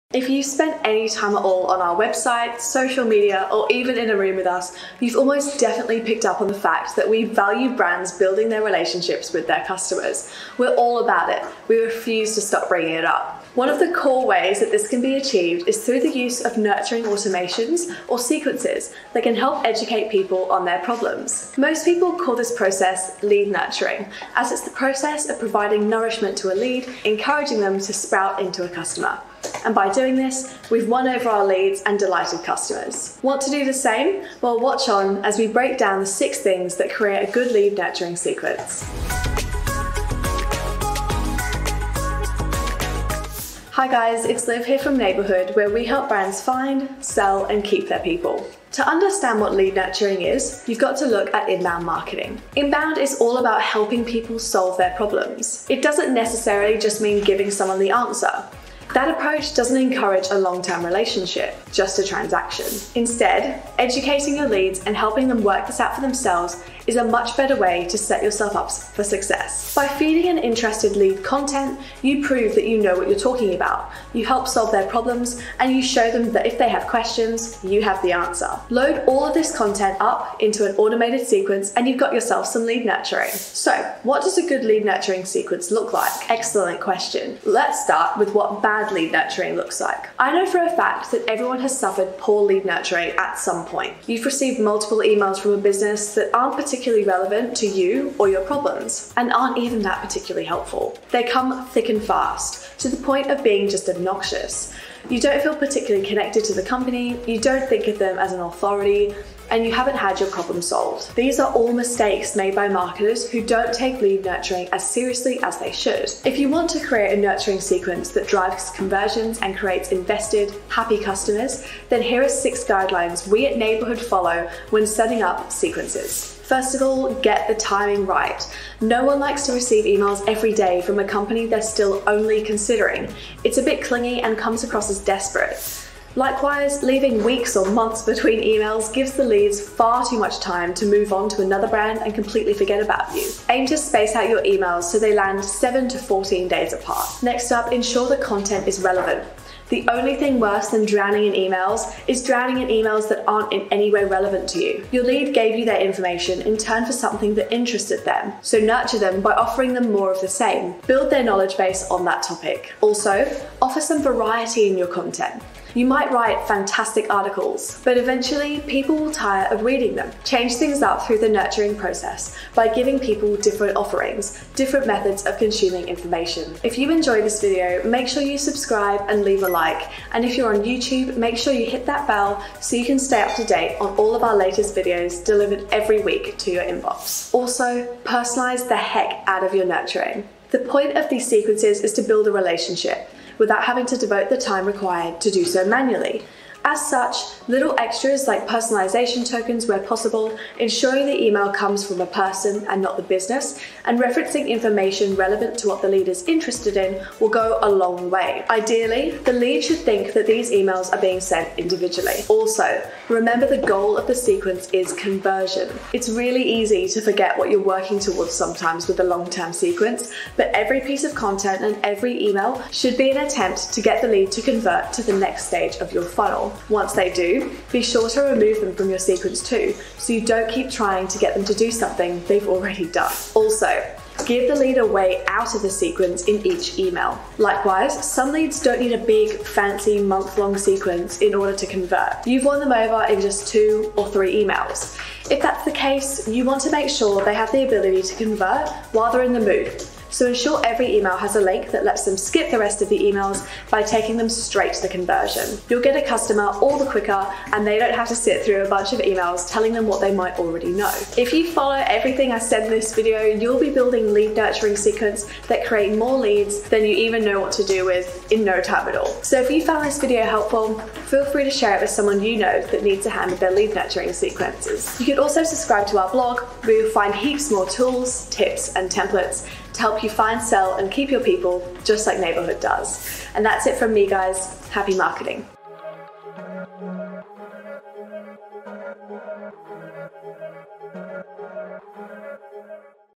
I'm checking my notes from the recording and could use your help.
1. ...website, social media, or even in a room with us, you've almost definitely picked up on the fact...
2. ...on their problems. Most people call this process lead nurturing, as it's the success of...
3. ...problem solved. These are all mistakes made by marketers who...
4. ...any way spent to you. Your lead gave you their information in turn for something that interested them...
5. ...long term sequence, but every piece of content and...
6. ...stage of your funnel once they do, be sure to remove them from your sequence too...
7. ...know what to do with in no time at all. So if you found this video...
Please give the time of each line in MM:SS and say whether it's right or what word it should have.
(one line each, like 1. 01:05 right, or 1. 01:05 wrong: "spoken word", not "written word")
1. 00:01 right
2. 00:20 wrong: "process", not "success"
3. 01:50 right
4. 02:33 wrong: "relevant", not "spent"
5. 03:39 right
6. 03:45 right
7. 04:27 right.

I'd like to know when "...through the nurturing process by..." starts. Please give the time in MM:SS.
02:51.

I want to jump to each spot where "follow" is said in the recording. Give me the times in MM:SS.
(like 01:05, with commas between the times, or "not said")
02:03, 04:21.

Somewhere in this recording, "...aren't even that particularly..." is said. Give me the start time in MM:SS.
01:39.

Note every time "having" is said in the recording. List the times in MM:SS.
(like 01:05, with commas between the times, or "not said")
03:13.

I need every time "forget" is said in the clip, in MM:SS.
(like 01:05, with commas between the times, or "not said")
02:22, 03:37.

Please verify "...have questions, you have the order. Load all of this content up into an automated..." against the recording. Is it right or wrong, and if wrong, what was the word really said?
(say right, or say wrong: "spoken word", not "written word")
wrong: "answer", not "order".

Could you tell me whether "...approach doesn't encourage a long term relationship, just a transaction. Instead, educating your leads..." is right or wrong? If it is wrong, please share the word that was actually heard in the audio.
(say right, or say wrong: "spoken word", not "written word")
right.